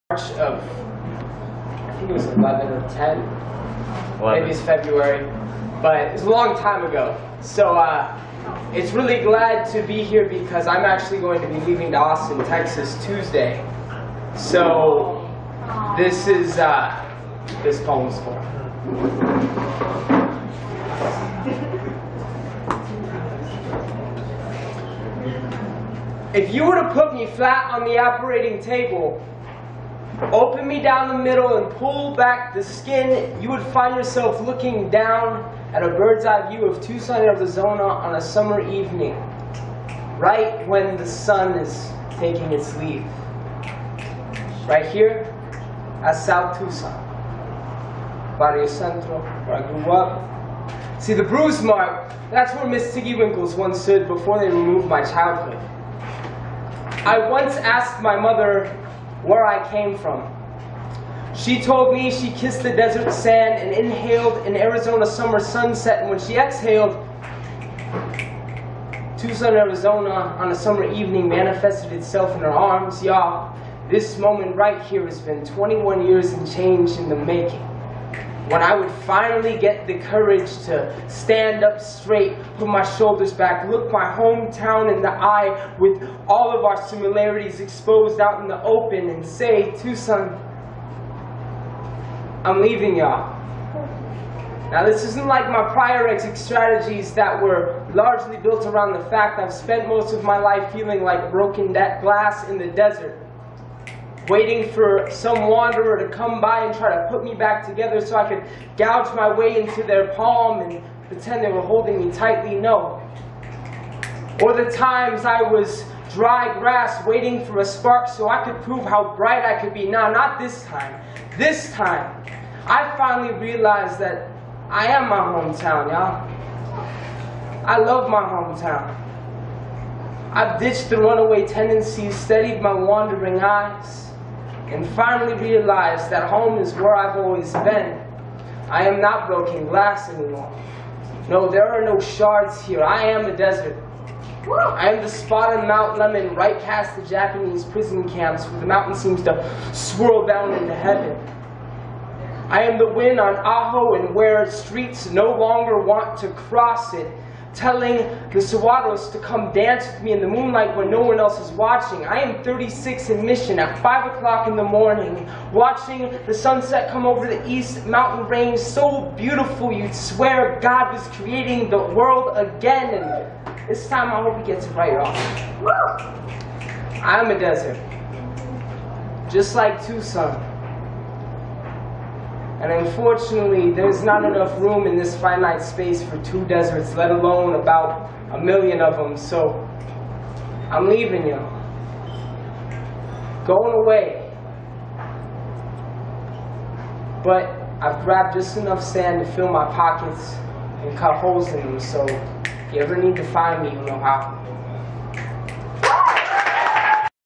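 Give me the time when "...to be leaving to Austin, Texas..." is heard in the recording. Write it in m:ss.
0:11.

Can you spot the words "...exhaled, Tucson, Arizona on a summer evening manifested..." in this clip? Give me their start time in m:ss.
1:06.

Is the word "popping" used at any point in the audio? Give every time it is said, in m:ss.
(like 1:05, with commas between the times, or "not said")
not said.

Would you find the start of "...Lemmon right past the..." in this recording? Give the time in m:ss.
2:25.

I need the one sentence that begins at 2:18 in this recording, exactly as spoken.
I am not broken glass anymore.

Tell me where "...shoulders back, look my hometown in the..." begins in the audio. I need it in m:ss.
1:22.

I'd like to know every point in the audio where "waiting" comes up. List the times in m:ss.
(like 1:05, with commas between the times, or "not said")
1:44, 1:57.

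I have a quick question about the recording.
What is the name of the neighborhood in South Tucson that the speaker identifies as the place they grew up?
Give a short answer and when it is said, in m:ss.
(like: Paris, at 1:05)
Barrio Centro, at 0:48.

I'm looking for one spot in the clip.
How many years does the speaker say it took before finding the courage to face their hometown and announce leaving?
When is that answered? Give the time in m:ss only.
1:15.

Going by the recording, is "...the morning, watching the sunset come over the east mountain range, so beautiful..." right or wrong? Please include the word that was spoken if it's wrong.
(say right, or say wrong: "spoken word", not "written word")
right.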